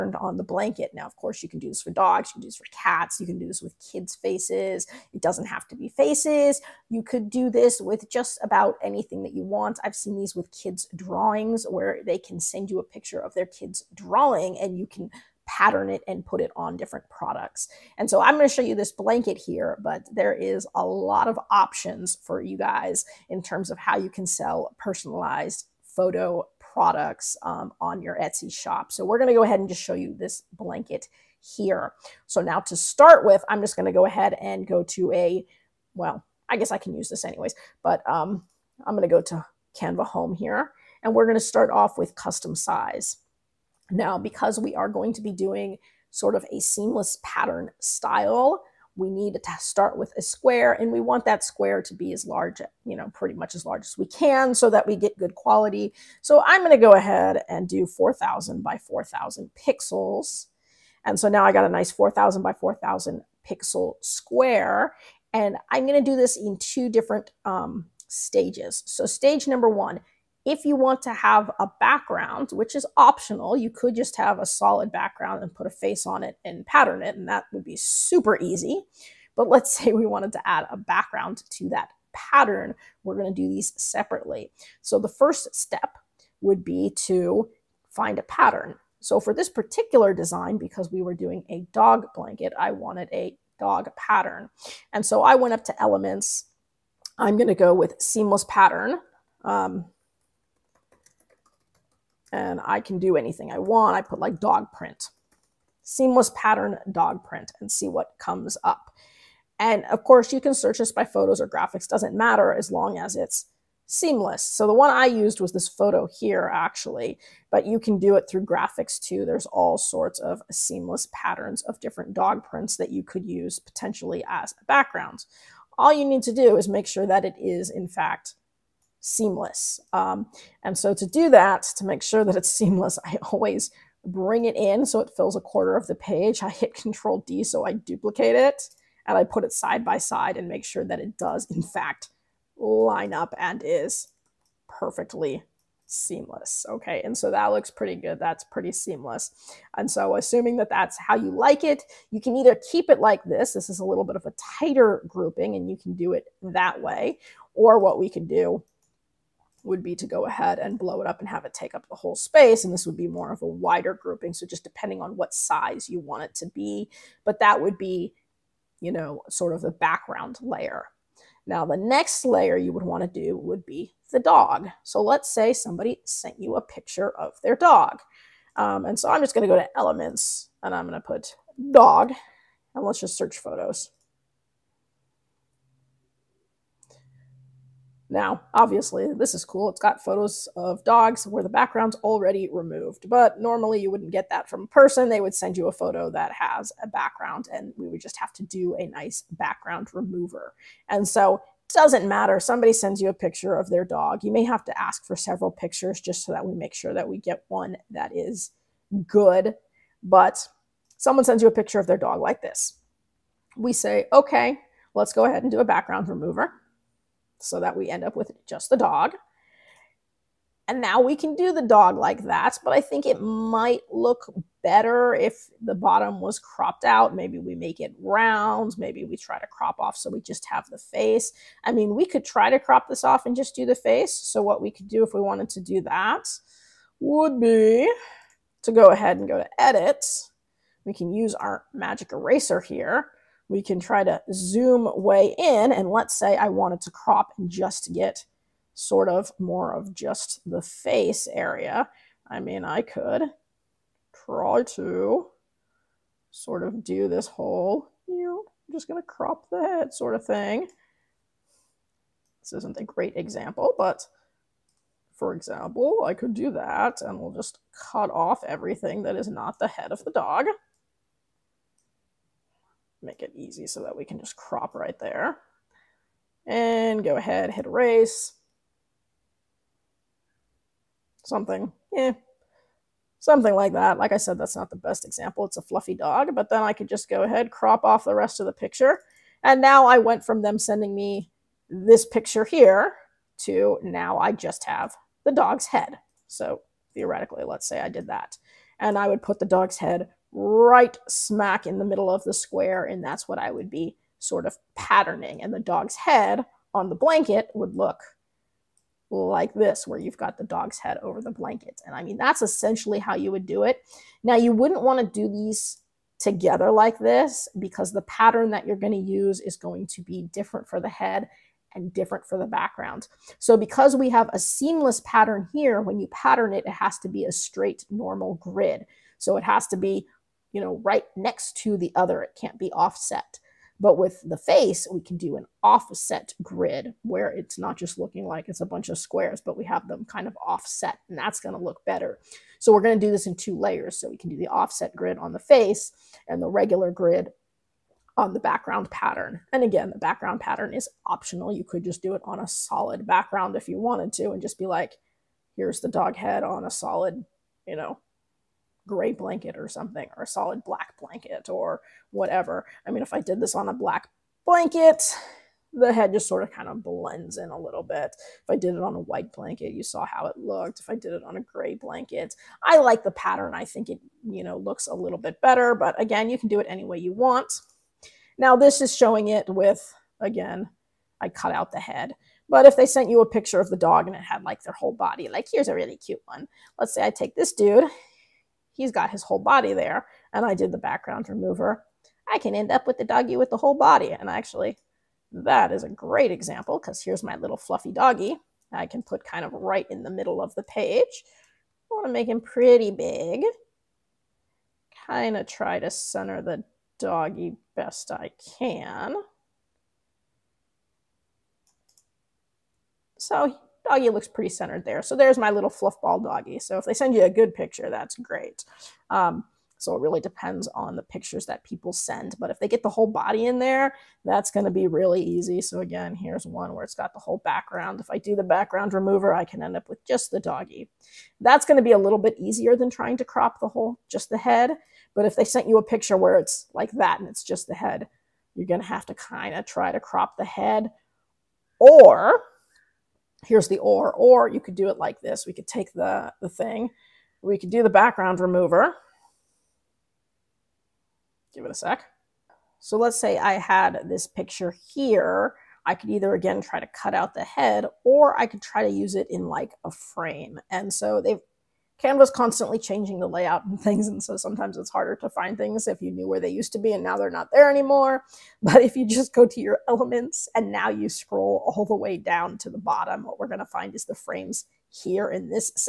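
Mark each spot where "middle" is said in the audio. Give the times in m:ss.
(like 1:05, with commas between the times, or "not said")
5:01, 6:40.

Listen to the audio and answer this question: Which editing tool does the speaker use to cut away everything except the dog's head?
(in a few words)
magic eraser.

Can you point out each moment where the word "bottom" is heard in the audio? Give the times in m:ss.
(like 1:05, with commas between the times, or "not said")
3:45, 7:52.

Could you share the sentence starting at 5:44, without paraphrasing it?
So we can do the offset grid on the face and the regular grid on the background pattern.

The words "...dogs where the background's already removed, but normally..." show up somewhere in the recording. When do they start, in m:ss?
3:10.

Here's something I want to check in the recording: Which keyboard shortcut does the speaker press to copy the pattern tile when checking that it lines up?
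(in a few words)
Control D.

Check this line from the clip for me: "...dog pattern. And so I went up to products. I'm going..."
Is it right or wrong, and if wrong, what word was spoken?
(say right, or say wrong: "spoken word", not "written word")
wrong: "elements", not "products".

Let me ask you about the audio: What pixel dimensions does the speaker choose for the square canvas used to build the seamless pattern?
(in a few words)
4,000 by 4,000.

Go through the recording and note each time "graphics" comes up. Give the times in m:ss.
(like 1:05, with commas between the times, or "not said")
1:51, 1:58.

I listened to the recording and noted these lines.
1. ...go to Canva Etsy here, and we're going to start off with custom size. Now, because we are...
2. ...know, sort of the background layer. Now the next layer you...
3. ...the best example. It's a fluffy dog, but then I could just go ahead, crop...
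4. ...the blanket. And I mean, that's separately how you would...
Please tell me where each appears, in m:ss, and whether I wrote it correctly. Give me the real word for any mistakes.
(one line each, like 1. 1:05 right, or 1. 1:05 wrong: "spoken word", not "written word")
1. 0:39 wrong: "Home", not "Etsy"
2. 2:48 right
3. 4:44 right
4. 5:11 wrong: "essentially", not "separately".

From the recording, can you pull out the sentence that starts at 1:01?
And so now I got a nice 4,000 by 4,000 pixel square.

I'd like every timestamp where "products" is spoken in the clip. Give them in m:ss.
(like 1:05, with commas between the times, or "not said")
0:17, 0:26.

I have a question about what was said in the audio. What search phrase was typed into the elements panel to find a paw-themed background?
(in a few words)
seamless pattern dog print.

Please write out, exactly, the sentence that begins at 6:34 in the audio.
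And actually, that is a great example because here's my little fluffy doggy.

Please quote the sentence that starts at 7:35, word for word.
I could either again try to cut out the head or I could try to use it in like a frame.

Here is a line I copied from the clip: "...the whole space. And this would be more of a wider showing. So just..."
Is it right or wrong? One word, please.
wrong.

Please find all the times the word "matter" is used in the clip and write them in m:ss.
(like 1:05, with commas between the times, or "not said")
1:52, 3:22.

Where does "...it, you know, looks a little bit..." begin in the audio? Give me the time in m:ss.
6:13.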